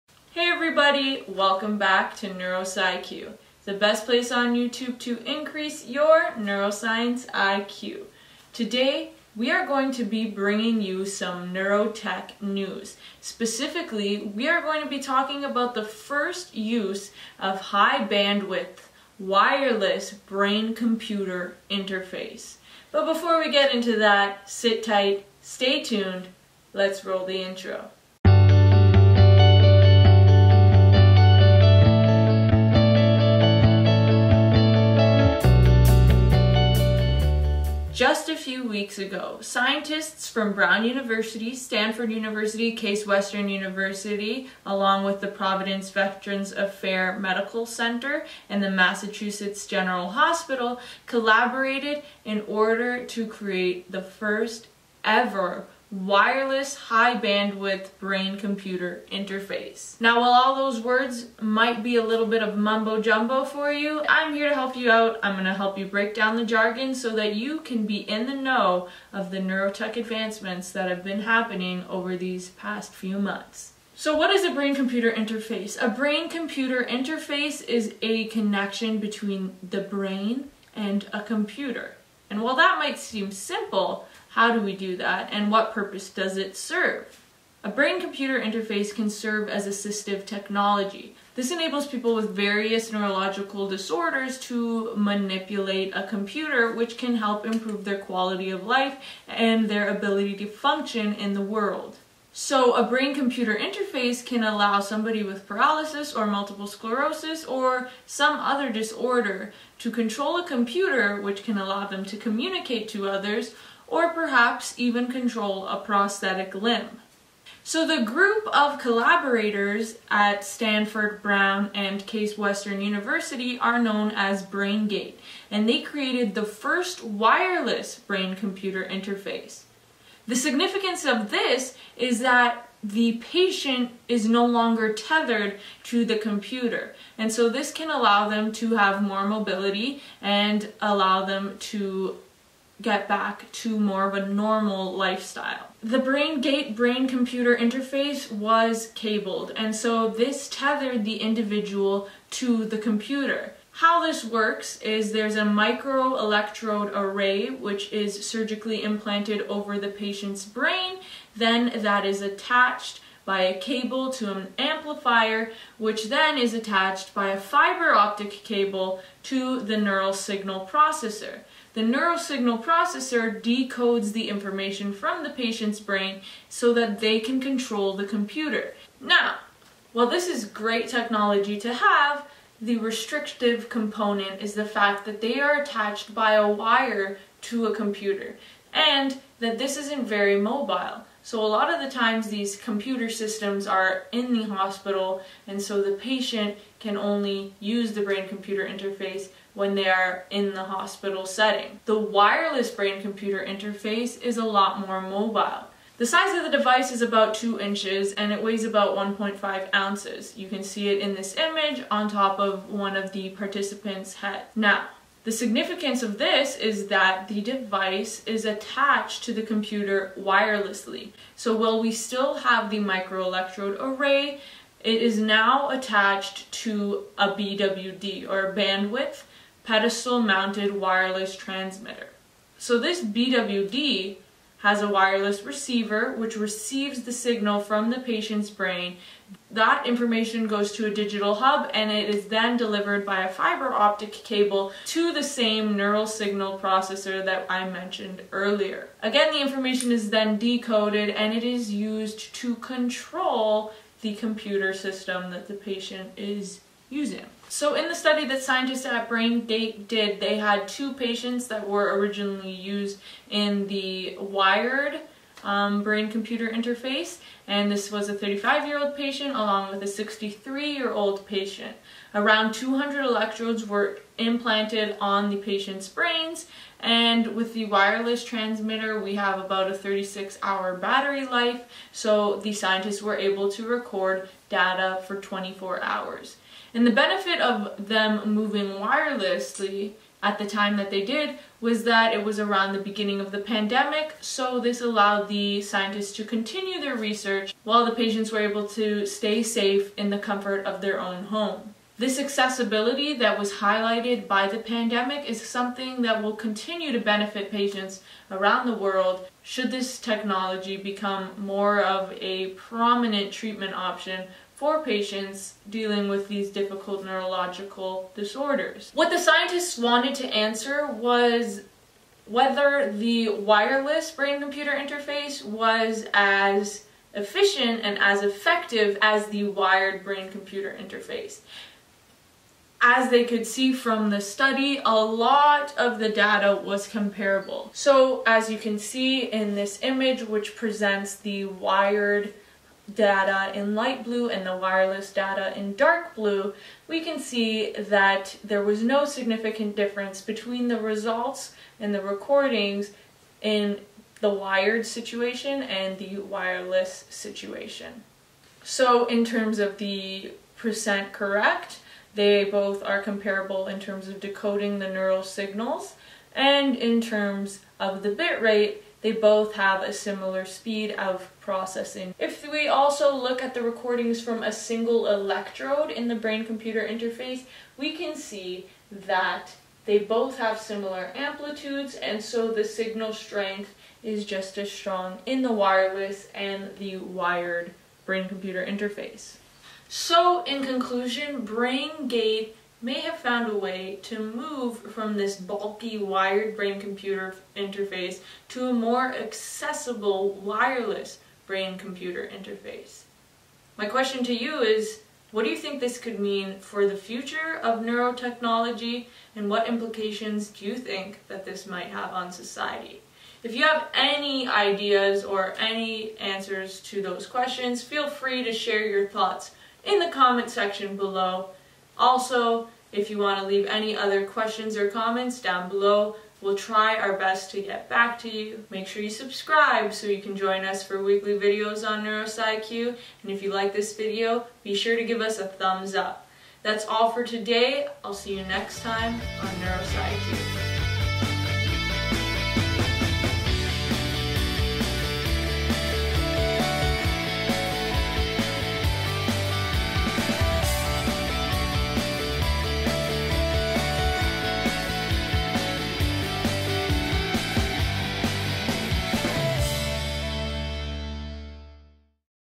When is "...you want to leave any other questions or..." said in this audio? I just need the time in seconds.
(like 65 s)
423 s.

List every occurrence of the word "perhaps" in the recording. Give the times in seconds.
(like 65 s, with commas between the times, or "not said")
114 s.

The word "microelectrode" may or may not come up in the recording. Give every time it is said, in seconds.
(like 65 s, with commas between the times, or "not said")
155 s, 222 s.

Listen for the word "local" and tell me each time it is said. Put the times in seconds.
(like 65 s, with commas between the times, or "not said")
not said.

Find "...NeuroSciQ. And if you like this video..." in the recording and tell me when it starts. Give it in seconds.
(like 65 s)
432 s.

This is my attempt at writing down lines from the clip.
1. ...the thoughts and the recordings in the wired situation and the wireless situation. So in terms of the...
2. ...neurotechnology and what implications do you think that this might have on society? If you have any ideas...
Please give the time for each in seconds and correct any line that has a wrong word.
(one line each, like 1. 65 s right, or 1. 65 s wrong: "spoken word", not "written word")
1. 350 s wrong: "results", not "thoughts"
2. 407 s right.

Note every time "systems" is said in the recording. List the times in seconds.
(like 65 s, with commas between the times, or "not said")
193 s, 254 s.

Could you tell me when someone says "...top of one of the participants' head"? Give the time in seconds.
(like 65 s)
212 s.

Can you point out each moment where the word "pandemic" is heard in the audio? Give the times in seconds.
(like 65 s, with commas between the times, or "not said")
293 s, 304 s.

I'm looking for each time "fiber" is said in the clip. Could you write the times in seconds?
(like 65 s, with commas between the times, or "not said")
167 s, 243 s.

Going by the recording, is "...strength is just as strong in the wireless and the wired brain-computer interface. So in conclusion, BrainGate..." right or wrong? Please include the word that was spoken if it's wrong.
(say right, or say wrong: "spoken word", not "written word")
right.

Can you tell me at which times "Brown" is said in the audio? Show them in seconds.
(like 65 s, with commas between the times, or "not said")
40 s, 121 s.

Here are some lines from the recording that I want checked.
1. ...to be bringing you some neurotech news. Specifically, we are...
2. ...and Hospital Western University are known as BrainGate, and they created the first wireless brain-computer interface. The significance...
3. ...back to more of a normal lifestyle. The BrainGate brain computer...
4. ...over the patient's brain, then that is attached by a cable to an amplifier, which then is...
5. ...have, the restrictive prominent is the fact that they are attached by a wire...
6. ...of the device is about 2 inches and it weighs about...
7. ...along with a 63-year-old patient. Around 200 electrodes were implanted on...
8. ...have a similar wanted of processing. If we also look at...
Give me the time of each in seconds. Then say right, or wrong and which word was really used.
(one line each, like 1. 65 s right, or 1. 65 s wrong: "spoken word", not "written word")
1. 9 s right
2. 121 s wrong: "Case", not "Hospital"
3. 143 s right
4. 159 s right
5. 181 s wrong: "component", not "prominent"
6. 206 s right
7. 269 s right
8. 369 s wrong: "speed", not "wanted".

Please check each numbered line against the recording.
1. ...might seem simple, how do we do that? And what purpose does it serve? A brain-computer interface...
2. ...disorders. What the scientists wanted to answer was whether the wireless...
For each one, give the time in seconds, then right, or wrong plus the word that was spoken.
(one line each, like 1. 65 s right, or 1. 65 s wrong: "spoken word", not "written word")
1. 82 s right
2. 318 s right.